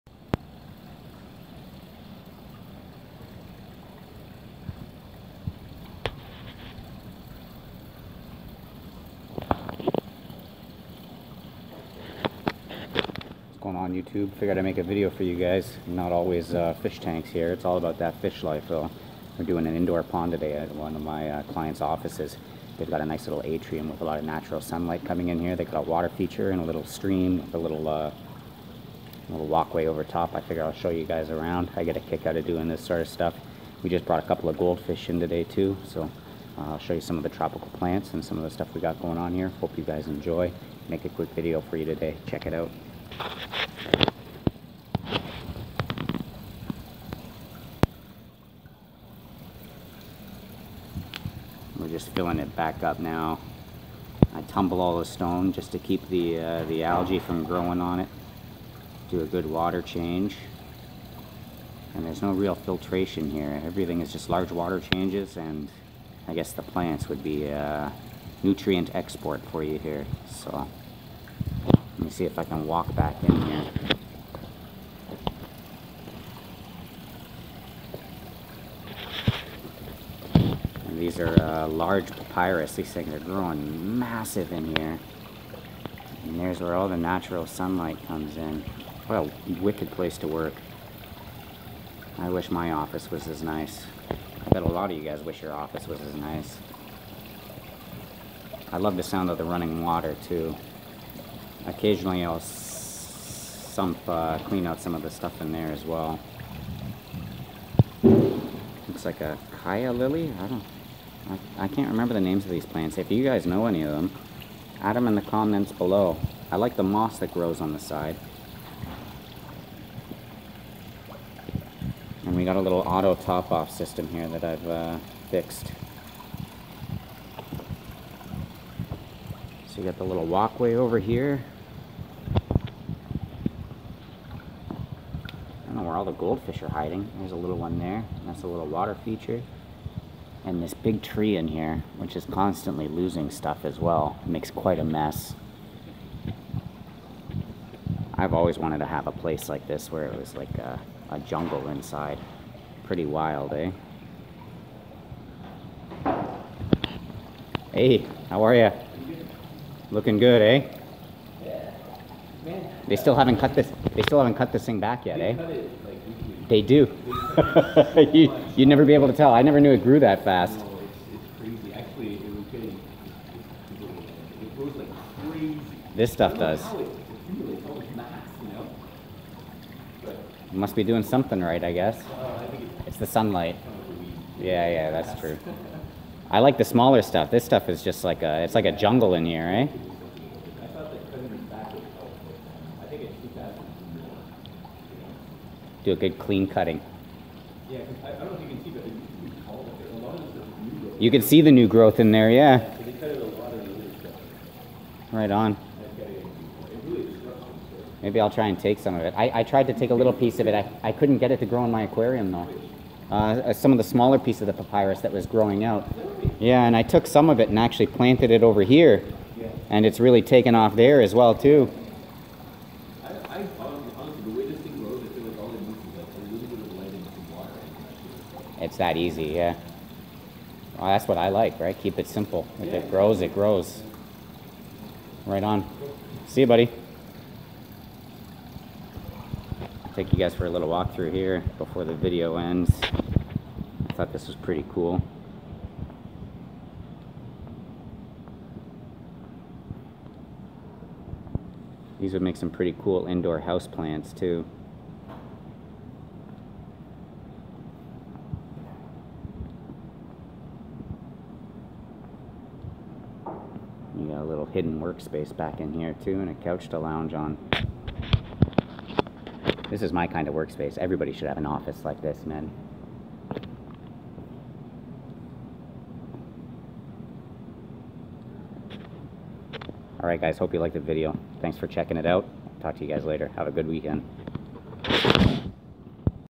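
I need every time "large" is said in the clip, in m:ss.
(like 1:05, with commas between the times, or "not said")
1:04, 1:21.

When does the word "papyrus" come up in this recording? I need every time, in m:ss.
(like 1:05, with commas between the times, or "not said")
1:22, 3:34.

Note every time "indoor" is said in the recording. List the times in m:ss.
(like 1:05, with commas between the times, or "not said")
0:19, 4:13.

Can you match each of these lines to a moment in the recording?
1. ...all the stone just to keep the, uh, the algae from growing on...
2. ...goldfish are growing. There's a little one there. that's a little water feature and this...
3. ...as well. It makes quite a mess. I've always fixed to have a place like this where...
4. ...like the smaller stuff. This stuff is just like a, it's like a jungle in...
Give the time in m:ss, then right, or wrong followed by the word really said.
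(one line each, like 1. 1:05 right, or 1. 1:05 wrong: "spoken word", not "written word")
1. 0:54 right
2. 2:16 wrong: "hiding", not "growing"
3. 2:23 wrong: "wanted", not "fixed"
4. 3:06 right.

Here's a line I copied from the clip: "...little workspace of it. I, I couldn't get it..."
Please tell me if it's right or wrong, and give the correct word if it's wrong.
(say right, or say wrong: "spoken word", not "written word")
wrong: "piece", not "workspace".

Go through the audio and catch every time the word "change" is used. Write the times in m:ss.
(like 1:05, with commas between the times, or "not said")
0:59, 1:04.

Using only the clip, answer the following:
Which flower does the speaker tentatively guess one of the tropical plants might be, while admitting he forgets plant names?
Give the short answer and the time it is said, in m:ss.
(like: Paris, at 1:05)
calla lily, at 1:49.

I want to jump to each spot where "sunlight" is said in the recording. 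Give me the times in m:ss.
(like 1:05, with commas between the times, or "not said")
0:24, 1:27, 3:03.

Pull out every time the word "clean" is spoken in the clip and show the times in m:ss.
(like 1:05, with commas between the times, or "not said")
1:44, 3:16.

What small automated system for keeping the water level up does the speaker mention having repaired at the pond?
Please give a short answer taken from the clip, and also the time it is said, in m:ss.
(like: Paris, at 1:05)
auto top-off system, at 2:02.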